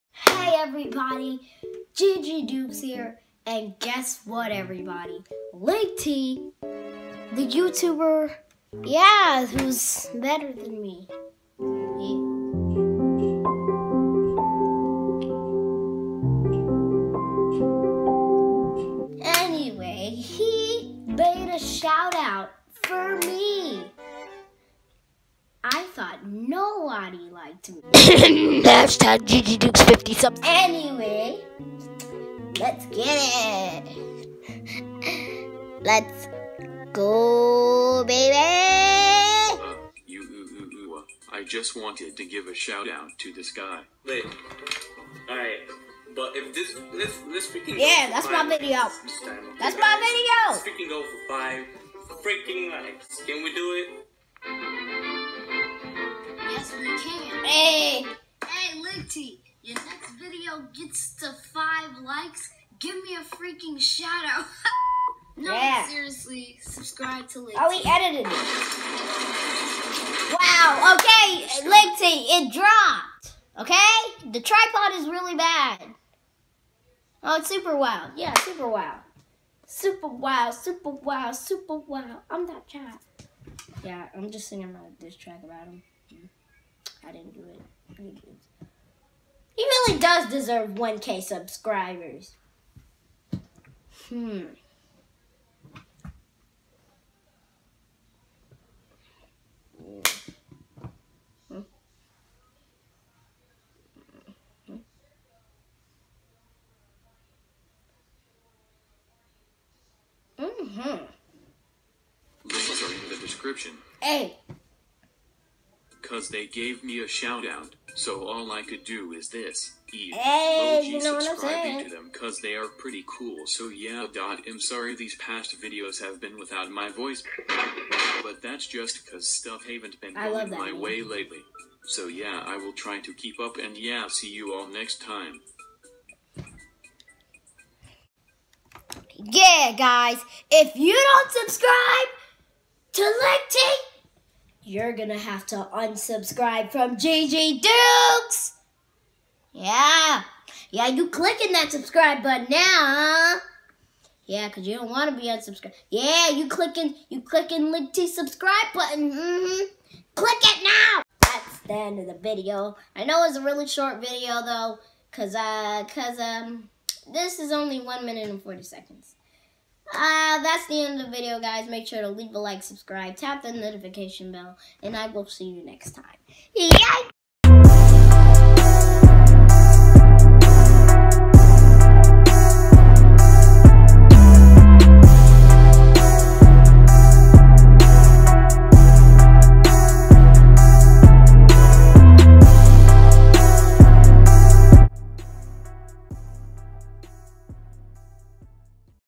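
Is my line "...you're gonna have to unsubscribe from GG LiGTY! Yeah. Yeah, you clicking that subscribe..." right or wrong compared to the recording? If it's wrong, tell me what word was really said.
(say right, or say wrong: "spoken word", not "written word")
wrong: "Dukes", not "LiGTY".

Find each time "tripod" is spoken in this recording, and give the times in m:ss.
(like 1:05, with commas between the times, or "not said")
1:14.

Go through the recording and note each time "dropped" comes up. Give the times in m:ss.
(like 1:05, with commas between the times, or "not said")
1:12.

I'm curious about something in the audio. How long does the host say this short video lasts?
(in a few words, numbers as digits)
1 minute and 40 seconds.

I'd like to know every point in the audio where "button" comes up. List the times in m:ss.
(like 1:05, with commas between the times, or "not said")
2:32, 2:38.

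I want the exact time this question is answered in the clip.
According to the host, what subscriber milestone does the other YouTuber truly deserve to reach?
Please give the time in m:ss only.
1:30.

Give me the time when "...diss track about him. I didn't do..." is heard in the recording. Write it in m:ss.
1:25.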